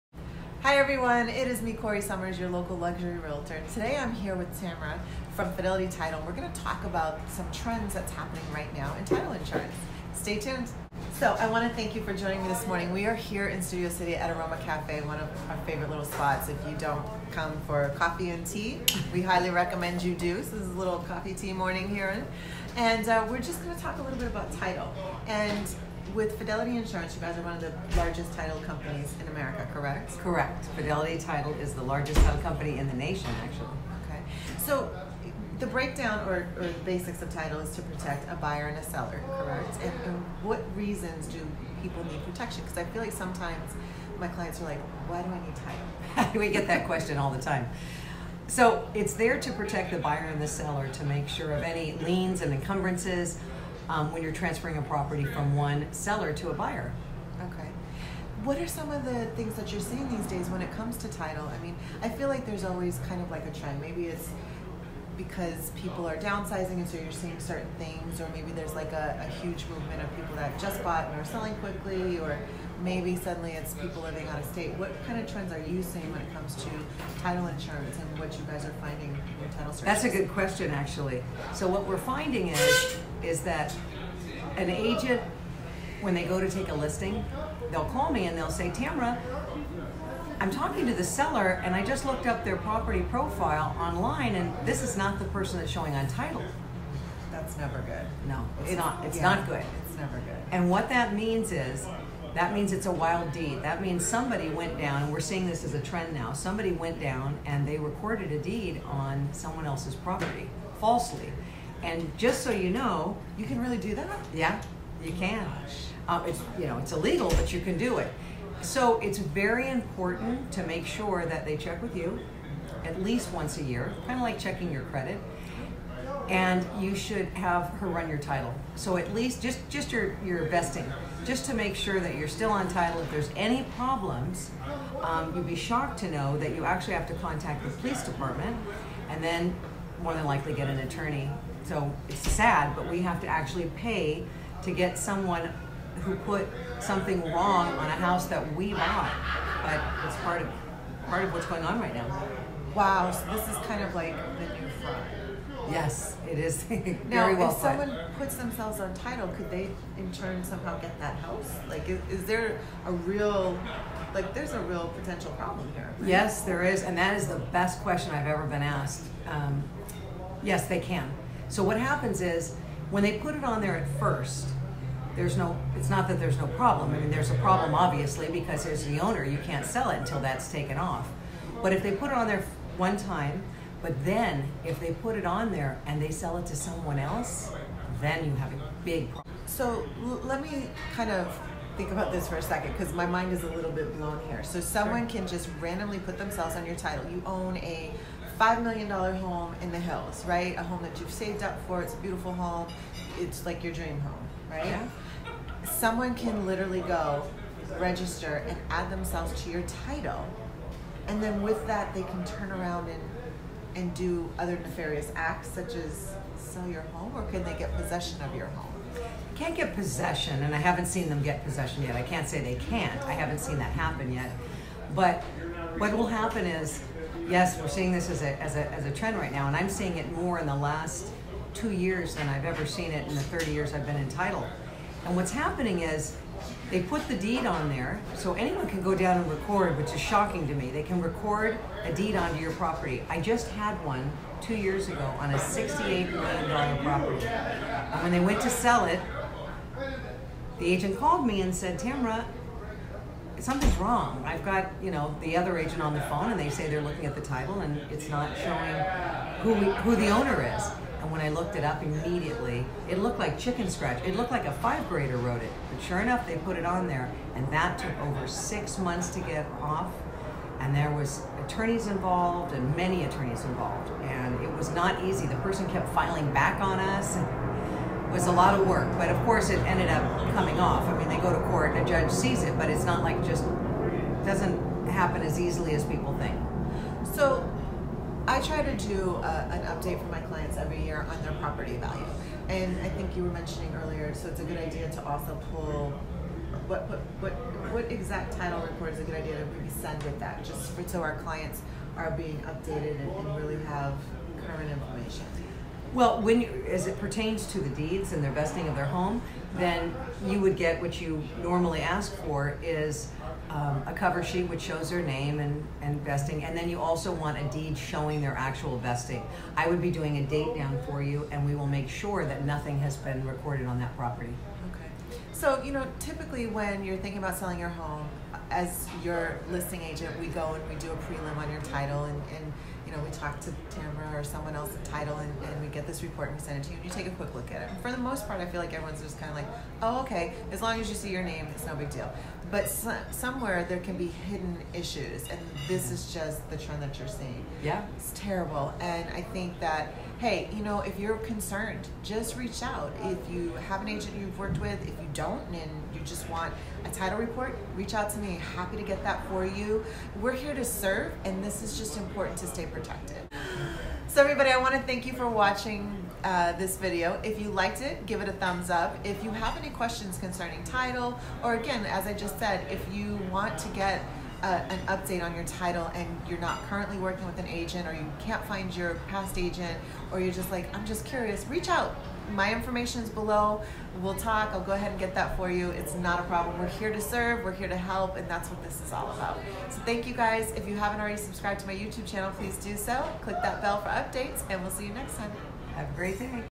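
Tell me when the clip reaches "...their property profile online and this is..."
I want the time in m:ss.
1:32.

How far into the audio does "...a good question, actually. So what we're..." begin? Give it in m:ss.
1:20.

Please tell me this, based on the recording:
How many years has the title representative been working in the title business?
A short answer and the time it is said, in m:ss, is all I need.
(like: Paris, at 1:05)
30 years, at 3:53.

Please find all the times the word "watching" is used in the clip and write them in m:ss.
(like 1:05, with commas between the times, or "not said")
6:05.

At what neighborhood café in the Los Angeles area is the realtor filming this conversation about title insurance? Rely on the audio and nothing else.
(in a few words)
Aroma Cafe.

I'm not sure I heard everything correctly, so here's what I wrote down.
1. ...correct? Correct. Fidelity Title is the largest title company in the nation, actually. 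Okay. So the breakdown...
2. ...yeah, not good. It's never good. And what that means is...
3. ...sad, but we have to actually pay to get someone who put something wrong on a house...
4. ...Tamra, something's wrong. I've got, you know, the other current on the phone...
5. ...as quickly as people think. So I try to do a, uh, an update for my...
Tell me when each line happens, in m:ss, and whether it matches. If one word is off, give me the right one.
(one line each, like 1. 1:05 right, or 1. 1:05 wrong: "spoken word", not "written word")
1. 0:29 right
2. 1:39 right
3. 2:22 right
4. 4:11 wrong: "agent", not "current"
5. 4:45 wrong: "easily", not "quickly".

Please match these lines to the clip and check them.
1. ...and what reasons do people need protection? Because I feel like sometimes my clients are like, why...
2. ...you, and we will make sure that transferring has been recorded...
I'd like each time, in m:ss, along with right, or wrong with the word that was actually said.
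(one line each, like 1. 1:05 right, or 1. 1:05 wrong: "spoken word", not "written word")
1. 0:40 right
2. 5:21 wrong: "nothing", not "transferring".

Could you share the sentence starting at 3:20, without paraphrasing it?
A home that you've saved up for.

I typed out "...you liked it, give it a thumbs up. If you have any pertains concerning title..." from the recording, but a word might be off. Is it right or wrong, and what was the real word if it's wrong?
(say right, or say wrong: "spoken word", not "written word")
wrong: "questions", not "pertains".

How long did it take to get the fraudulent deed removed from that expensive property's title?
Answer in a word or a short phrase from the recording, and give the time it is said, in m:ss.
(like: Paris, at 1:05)
over six months, at 4:28.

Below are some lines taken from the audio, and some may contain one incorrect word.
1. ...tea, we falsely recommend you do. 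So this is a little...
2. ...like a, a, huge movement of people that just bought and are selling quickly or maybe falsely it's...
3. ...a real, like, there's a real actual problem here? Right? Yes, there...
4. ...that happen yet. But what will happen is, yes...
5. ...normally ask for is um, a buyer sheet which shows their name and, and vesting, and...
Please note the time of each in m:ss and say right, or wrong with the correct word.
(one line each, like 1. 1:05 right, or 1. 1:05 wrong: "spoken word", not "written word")
1. 0:18 wrong: "highly", not "falsely"
2. 1:08 wrong: "suddenly", not "falsely"
3. 2:42 wrong: "potential", not "actual"
4. 3:43 right
5. 5:11 wrong: "cover", not "buyer".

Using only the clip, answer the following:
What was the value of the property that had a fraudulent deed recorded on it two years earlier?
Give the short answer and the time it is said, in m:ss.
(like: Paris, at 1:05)
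$68 million, at 4:05.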